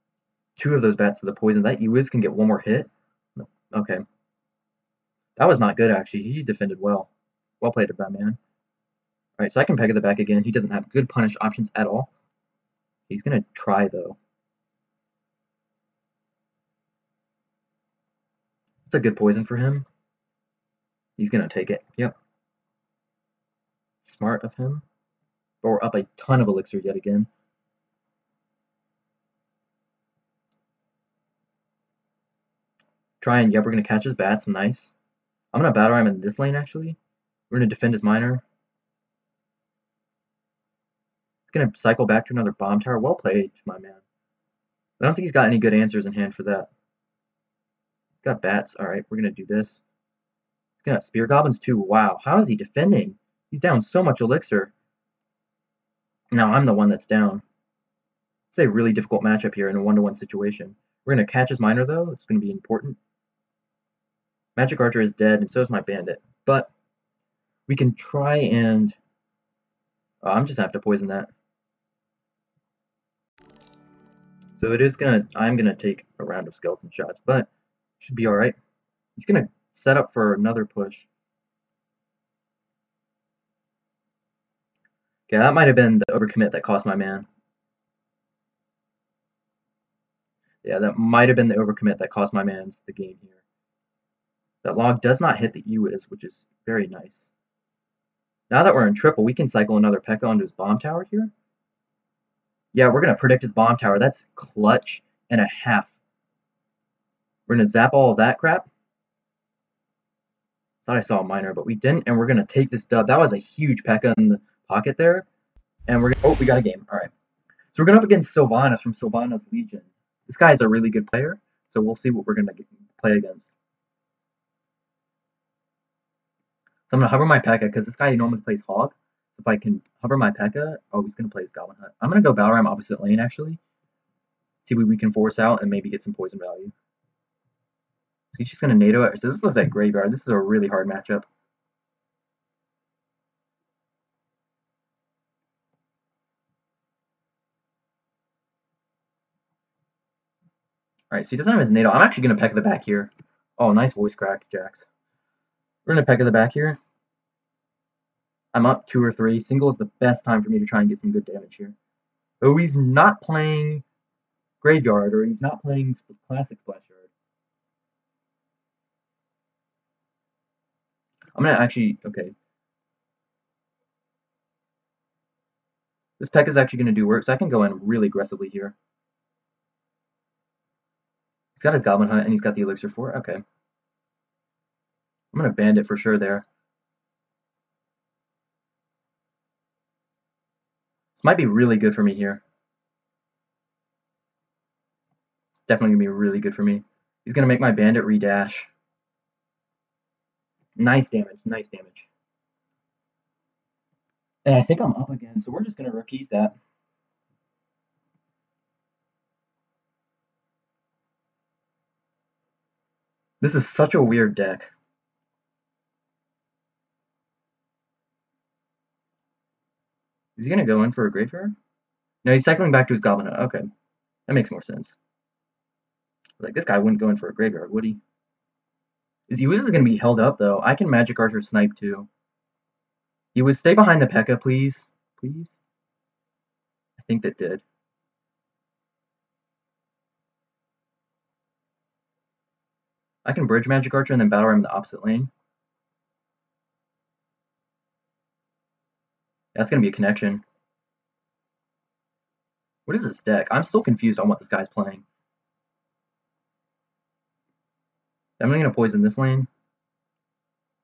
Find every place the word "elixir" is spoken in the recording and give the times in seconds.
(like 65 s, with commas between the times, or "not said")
26 s, 54 s, 182 s.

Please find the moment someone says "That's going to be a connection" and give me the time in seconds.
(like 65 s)
249 s.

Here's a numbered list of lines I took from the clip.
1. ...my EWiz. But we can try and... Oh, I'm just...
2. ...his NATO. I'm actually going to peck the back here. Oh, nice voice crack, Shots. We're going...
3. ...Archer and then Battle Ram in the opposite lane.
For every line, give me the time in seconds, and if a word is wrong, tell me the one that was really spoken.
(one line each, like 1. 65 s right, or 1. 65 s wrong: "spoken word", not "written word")
1. 65 s wrong: "Bandit", not "EWiz"
2. 151 s wrong: "Jax", not "Shots"
3. 243 s right.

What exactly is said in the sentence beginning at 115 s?
And we're gonna, oh, we got a game.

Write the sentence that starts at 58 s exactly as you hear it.
It's a really difficult matchup here in a one-to-one -one situation.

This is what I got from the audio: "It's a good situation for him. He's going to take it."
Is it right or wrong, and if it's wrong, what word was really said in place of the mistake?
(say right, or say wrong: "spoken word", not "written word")
wrong: "poison", not "situation".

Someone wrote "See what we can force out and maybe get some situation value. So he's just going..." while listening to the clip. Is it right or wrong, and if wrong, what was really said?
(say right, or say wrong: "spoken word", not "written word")
wrong: "poison", not "situation".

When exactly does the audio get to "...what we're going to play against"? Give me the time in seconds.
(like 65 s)
122 s.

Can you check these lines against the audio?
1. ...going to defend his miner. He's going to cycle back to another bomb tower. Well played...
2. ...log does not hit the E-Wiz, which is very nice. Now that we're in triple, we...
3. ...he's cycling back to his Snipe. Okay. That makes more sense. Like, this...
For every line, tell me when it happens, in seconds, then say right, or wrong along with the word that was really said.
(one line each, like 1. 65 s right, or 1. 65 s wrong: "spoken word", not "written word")
1. 37 s right
2. 94 s right
3. 222 s wrong: "Goblin", not "Snipe".